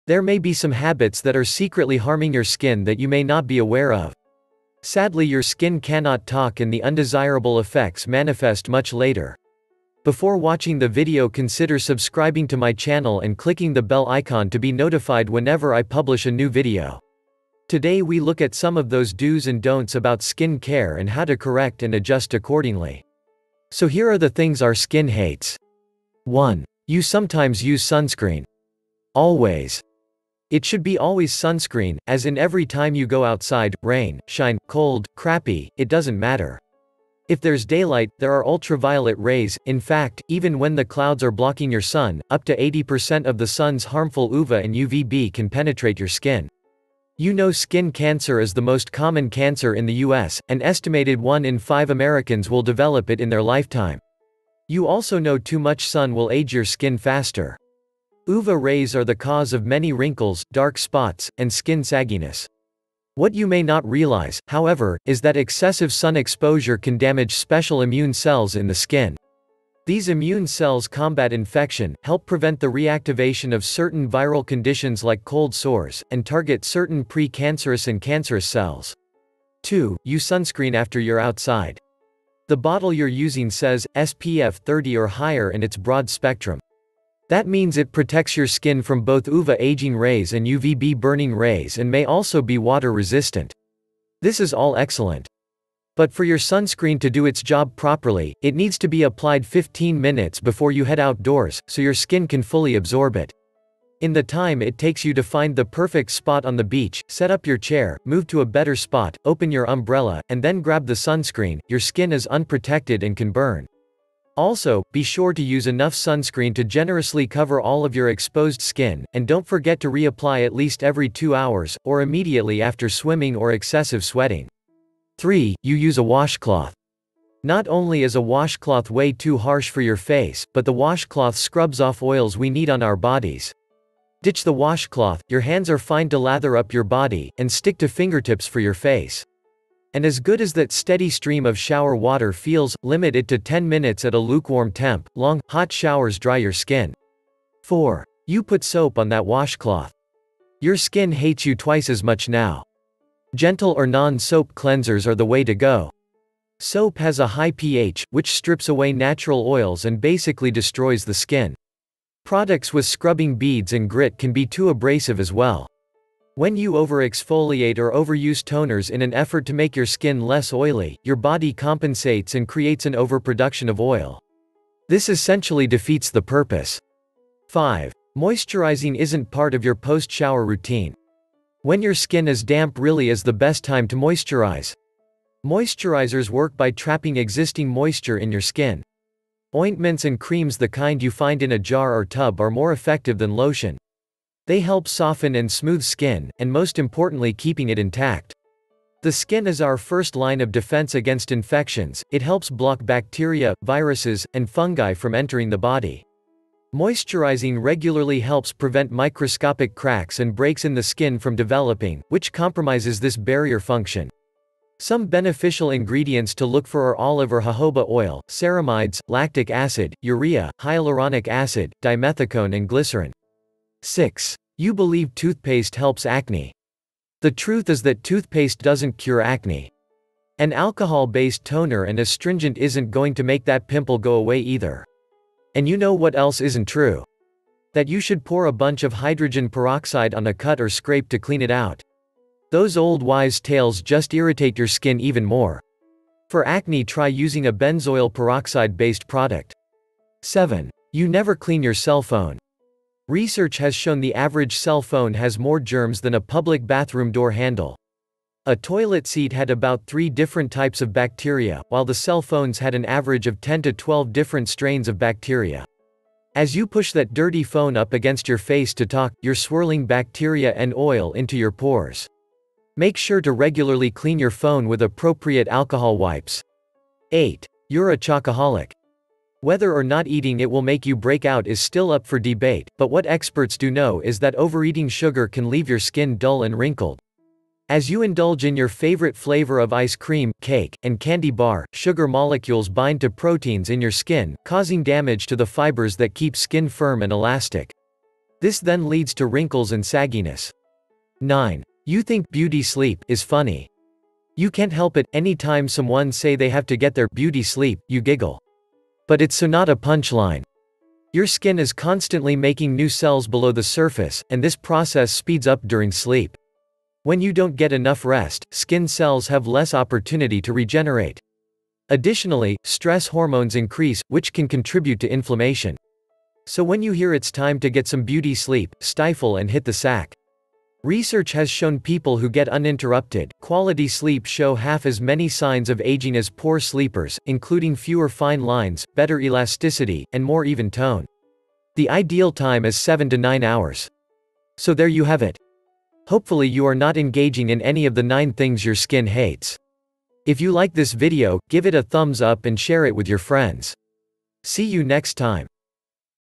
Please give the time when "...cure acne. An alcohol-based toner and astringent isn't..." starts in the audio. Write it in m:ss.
3:48.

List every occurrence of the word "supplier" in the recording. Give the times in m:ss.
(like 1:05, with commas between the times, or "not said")
not said.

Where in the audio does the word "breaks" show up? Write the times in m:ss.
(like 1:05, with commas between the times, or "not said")
3:30, 4:40.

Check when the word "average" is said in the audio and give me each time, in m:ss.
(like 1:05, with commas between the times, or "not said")
4:14, 4:22.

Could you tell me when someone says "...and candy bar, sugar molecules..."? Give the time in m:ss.
4:50.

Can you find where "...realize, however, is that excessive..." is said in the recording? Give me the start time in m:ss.
1:03.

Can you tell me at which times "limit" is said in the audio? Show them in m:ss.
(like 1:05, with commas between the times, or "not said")
2:22.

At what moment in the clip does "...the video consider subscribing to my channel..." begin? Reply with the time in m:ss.
0:10.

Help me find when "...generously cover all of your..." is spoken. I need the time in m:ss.
1:56.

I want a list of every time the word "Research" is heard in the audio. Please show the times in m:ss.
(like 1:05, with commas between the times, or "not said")
4:13, 5:30.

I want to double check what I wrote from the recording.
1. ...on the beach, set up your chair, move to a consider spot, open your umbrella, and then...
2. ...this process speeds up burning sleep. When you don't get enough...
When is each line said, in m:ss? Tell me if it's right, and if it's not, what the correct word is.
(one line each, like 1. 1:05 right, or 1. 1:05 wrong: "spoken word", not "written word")
1. 1:46 wrong: "better", not "consider"
2. 5:14 wrong: "during", not "burning".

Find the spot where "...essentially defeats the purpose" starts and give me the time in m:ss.
2:55.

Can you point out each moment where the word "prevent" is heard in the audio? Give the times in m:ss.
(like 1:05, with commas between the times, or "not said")
1:12, 3:28.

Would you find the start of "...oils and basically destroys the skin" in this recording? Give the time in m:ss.
2:39.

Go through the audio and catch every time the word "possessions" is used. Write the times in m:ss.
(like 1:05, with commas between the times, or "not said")
not said.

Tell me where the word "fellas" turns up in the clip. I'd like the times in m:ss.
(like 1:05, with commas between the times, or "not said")
not said.